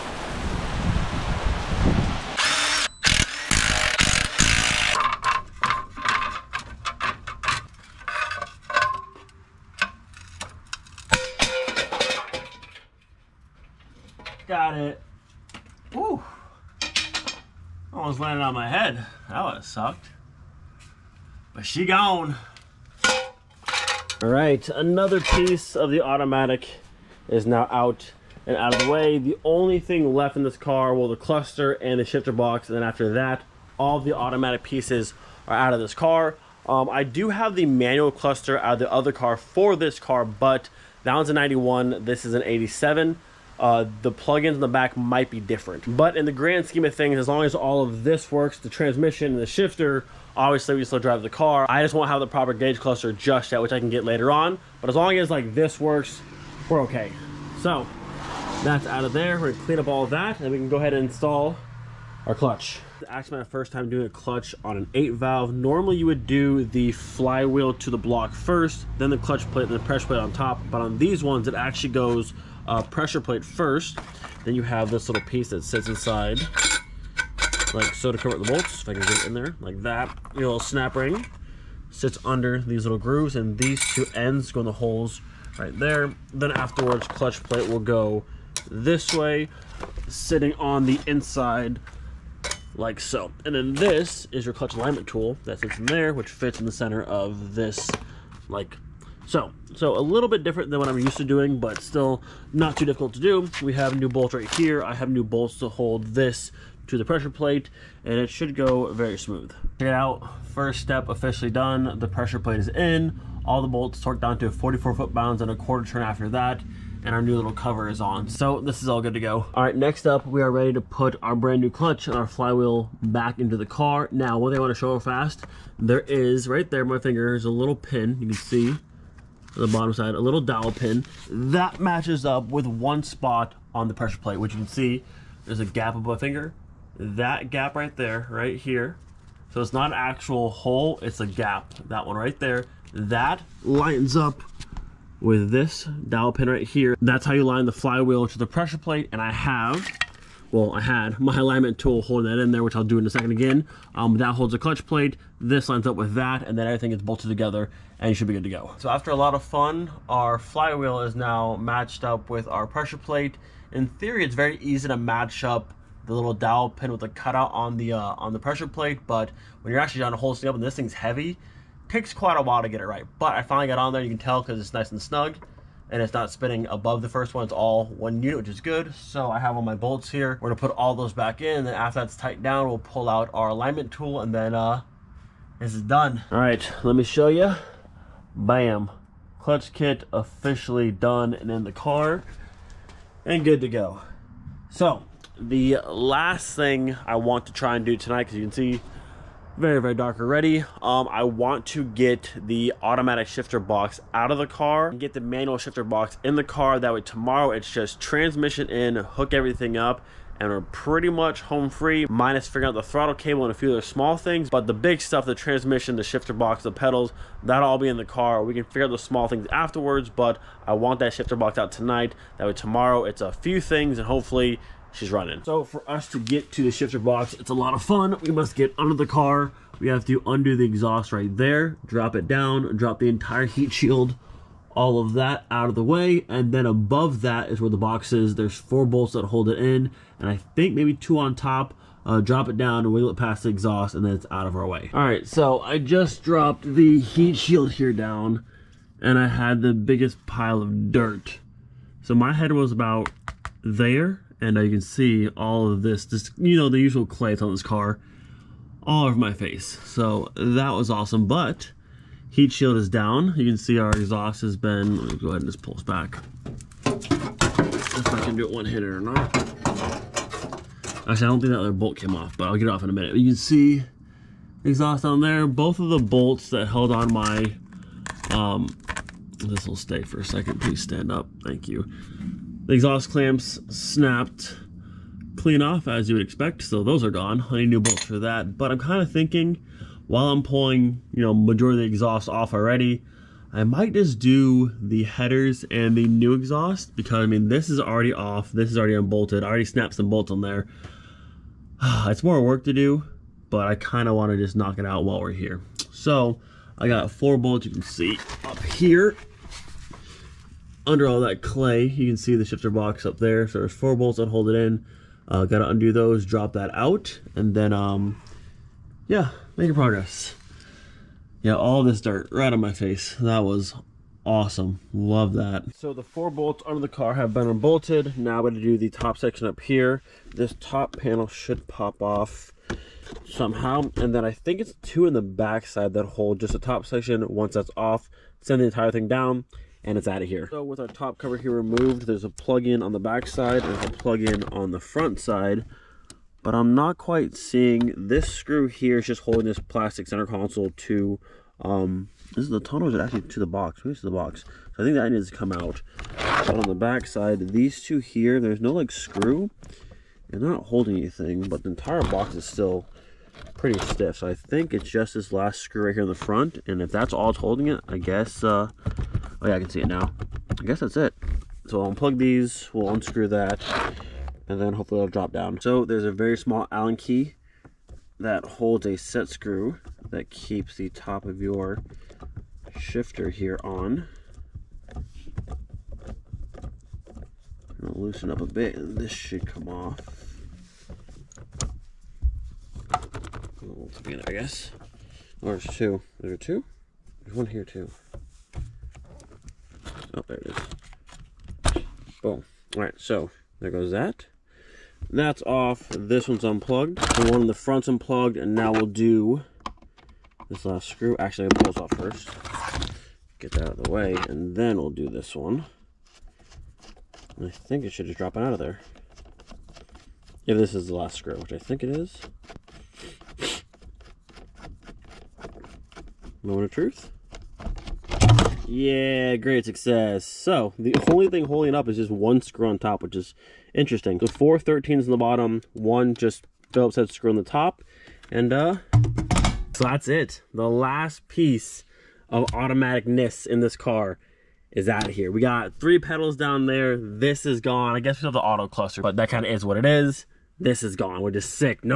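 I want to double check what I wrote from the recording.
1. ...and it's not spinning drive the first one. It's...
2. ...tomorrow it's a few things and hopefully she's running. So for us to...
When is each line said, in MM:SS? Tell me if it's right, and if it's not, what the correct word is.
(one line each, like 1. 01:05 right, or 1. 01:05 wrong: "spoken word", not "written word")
1. 02:55 wrong: "above", not "drive"
2. 03:42 right.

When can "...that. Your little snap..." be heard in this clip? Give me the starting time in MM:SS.
01:19.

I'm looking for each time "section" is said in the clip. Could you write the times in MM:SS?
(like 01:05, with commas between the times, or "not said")
05:29, 05:36.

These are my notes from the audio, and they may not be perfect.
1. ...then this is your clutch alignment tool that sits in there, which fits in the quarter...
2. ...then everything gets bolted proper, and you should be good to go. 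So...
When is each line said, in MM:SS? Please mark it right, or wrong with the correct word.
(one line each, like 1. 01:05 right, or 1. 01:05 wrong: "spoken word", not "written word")
1. 01:33 wrong: "center", not "quarter"
2. 02:36 wrong: "together", not "proper".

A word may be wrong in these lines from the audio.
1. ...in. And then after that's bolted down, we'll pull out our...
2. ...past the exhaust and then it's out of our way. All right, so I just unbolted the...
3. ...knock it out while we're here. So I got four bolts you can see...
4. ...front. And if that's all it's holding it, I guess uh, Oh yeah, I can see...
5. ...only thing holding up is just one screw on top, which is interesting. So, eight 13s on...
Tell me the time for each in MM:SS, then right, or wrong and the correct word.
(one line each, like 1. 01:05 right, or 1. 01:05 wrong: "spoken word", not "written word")
1. 03:01 wrong: "tightened", not "bolted"
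2. 04:03 wrong: "dropped", not "unbolted"
3. 05:04 right
4. 06:06 right
5. 07:11 wrong: "four", not "eight".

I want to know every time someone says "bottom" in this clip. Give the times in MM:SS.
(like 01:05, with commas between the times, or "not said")
02:09, 07:15.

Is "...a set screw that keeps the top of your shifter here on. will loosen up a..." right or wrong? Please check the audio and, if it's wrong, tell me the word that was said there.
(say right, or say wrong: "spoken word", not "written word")
right.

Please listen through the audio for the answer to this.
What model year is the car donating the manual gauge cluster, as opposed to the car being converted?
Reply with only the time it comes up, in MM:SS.
00:41.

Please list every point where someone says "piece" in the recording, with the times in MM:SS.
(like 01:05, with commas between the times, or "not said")
00:25, 00:34, 01:15, 07:21.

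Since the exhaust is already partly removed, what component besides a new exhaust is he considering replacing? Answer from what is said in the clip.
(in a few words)
headers.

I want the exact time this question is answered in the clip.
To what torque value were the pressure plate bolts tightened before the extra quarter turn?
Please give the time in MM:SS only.
01:54.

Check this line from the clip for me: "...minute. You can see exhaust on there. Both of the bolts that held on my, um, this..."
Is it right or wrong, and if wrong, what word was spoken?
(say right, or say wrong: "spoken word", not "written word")
right.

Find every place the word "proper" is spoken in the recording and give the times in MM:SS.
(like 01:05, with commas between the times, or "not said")
00:52.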